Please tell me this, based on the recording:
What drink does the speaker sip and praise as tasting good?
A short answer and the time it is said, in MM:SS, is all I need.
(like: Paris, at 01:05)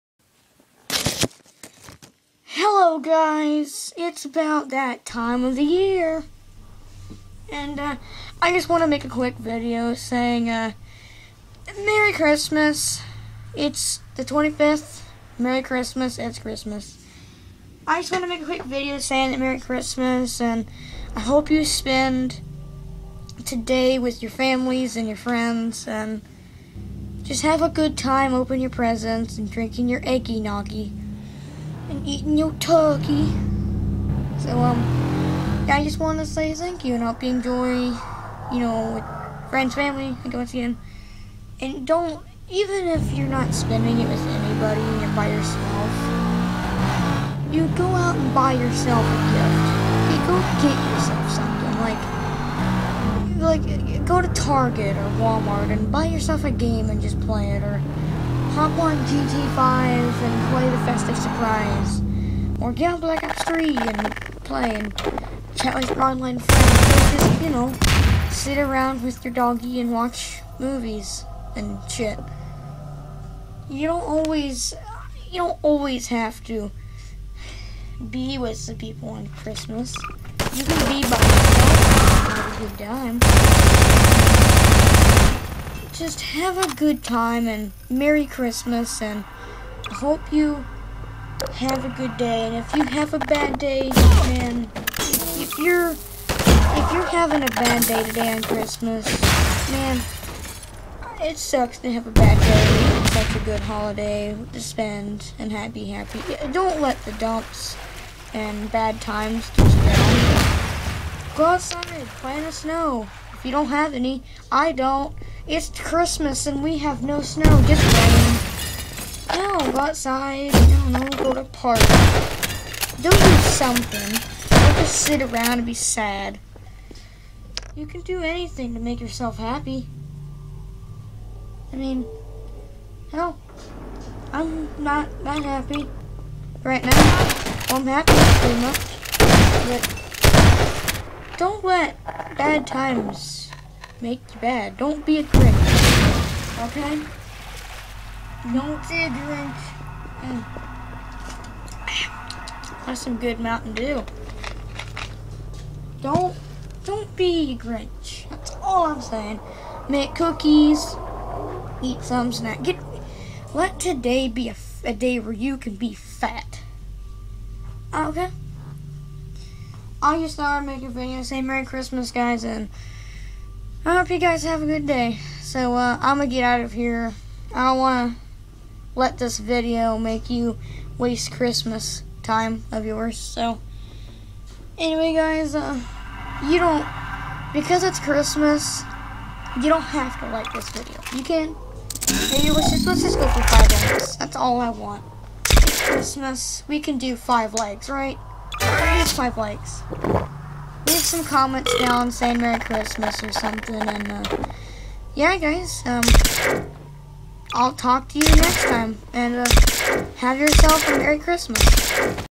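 Mountain Dew, at 02:33.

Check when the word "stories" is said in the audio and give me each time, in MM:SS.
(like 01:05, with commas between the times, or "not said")
not said.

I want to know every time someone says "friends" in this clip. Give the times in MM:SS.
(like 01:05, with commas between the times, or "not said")
00:25, 00:39, 01:06.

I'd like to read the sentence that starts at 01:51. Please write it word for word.
Go outside play in the snow.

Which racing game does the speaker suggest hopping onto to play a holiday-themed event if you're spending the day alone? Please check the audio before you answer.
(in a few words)
GT5.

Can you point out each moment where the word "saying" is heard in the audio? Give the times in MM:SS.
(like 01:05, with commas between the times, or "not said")
00:09, 00:18, 02:39, 03:22.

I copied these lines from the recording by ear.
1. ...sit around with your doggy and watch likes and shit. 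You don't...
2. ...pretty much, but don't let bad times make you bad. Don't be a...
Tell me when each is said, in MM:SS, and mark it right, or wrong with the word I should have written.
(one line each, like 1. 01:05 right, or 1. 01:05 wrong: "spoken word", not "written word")
1. 01:08 wrong: "movies", not "likes"
2. 02:18 right.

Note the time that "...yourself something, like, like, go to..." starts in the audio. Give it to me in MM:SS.
00:50.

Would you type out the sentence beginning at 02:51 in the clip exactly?
Say Merry Christmas, guys, and I hope you guys have a good day.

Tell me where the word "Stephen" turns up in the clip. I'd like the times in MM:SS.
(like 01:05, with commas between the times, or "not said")
not said.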